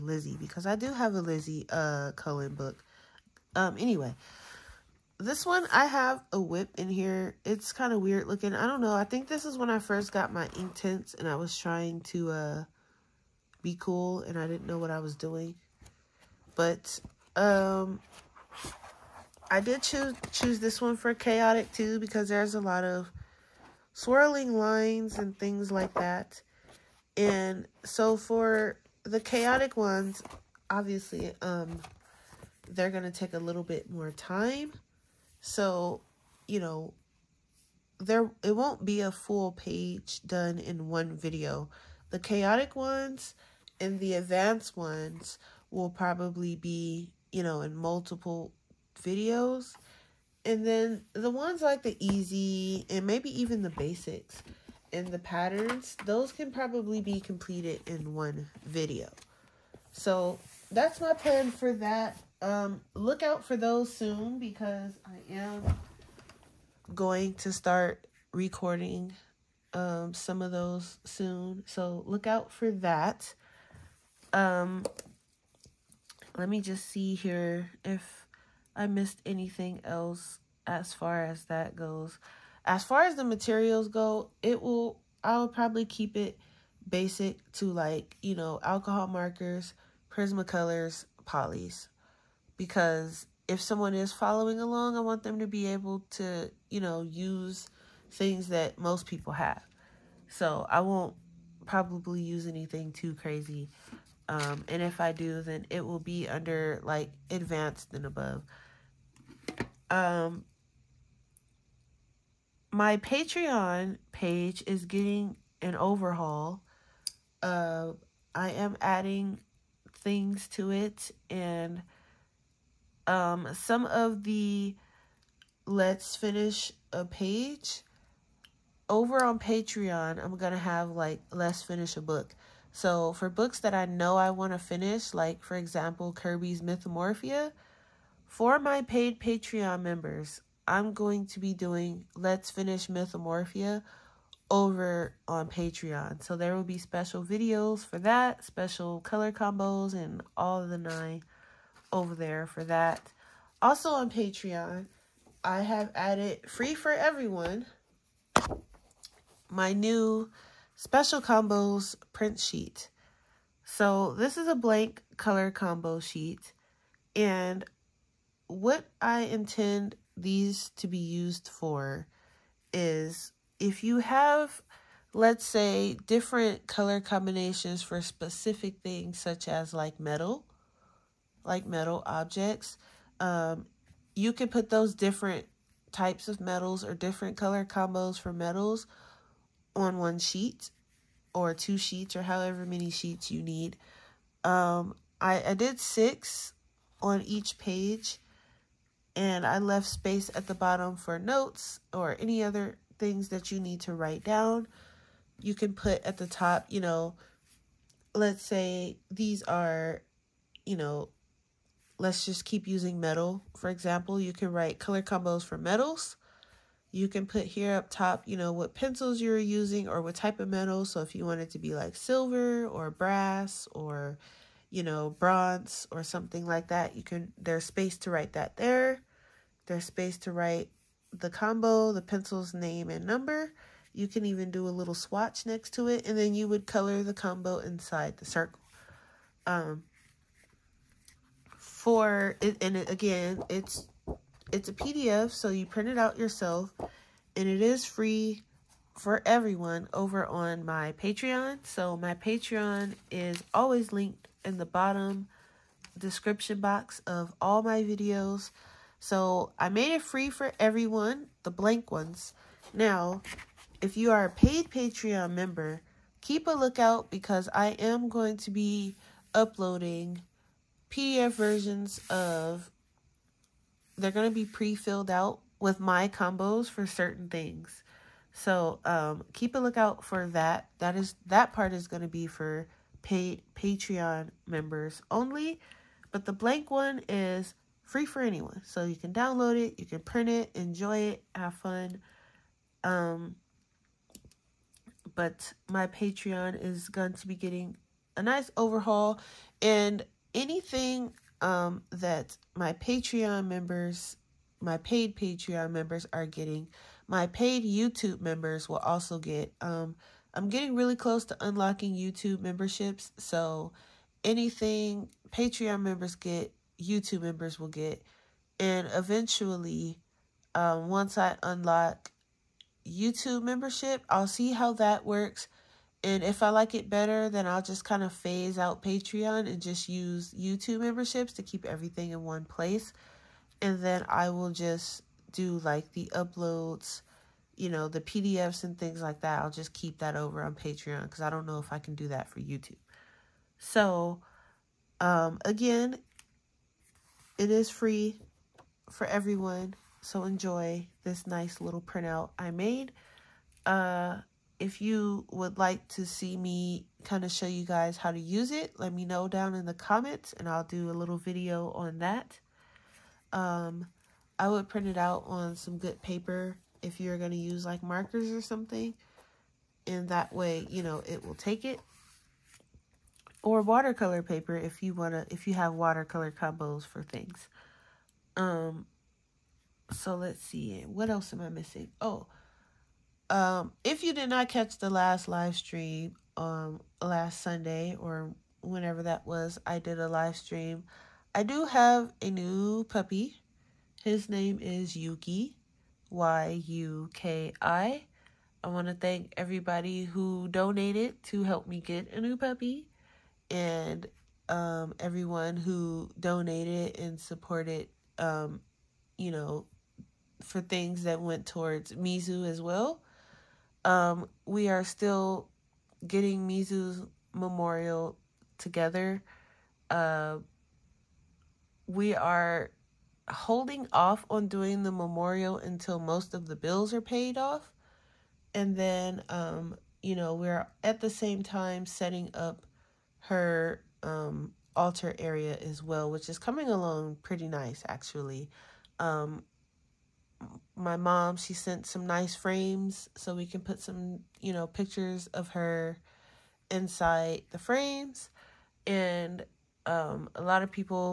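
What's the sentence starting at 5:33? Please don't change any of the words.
And then I will just do like the uploads, you know, the PDFs and things like that.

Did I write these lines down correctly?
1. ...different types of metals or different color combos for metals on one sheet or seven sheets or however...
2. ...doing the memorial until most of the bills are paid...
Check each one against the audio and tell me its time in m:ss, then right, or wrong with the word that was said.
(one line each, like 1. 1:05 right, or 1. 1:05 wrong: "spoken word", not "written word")
1. 3:04 wrong: "two", not "seven"
2. 7:04 right.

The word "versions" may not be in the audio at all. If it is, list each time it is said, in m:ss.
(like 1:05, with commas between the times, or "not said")
4:31.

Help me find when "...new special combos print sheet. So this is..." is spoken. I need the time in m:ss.
2:39.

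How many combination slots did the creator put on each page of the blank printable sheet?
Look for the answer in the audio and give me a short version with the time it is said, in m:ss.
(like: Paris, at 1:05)
6, at 3:15.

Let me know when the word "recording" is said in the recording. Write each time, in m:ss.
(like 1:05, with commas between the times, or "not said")
1:08.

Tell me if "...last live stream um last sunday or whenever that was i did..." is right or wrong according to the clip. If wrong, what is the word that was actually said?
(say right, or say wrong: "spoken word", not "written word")
right.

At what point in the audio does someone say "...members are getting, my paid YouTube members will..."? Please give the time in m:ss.
5:05.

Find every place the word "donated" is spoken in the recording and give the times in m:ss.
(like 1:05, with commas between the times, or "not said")
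6:40, 6:46.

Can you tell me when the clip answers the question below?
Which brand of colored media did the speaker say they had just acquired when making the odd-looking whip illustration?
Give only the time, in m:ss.
0:10.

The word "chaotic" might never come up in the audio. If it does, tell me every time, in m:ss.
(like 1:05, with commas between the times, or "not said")
0:21, 0:29, 0:42.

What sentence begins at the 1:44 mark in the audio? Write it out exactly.
Um, and if I do, then it will be under like advanced and above um, my Patreon page is getting an overhaul.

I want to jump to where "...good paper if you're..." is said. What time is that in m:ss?
6:05.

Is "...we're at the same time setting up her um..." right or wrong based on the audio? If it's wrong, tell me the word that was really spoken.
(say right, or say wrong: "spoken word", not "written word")
right.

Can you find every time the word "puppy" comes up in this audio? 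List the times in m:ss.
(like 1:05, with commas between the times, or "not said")
6:32, 6:42.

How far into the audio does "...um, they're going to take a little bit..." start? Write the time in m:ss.
0:31.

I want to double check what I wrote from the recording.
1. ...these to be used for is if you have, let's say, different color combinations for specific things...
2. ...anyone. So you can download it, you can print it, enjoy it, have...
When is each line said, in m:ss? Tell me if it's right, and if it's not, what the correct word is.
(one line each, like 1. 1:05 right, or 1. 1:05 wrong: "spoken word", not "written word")
1. 2:50 right
2. 4:48 right.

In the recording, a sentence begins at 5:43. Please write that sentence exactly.
So, um, again, it is free for everyone, so enjoy this nice little printout I made.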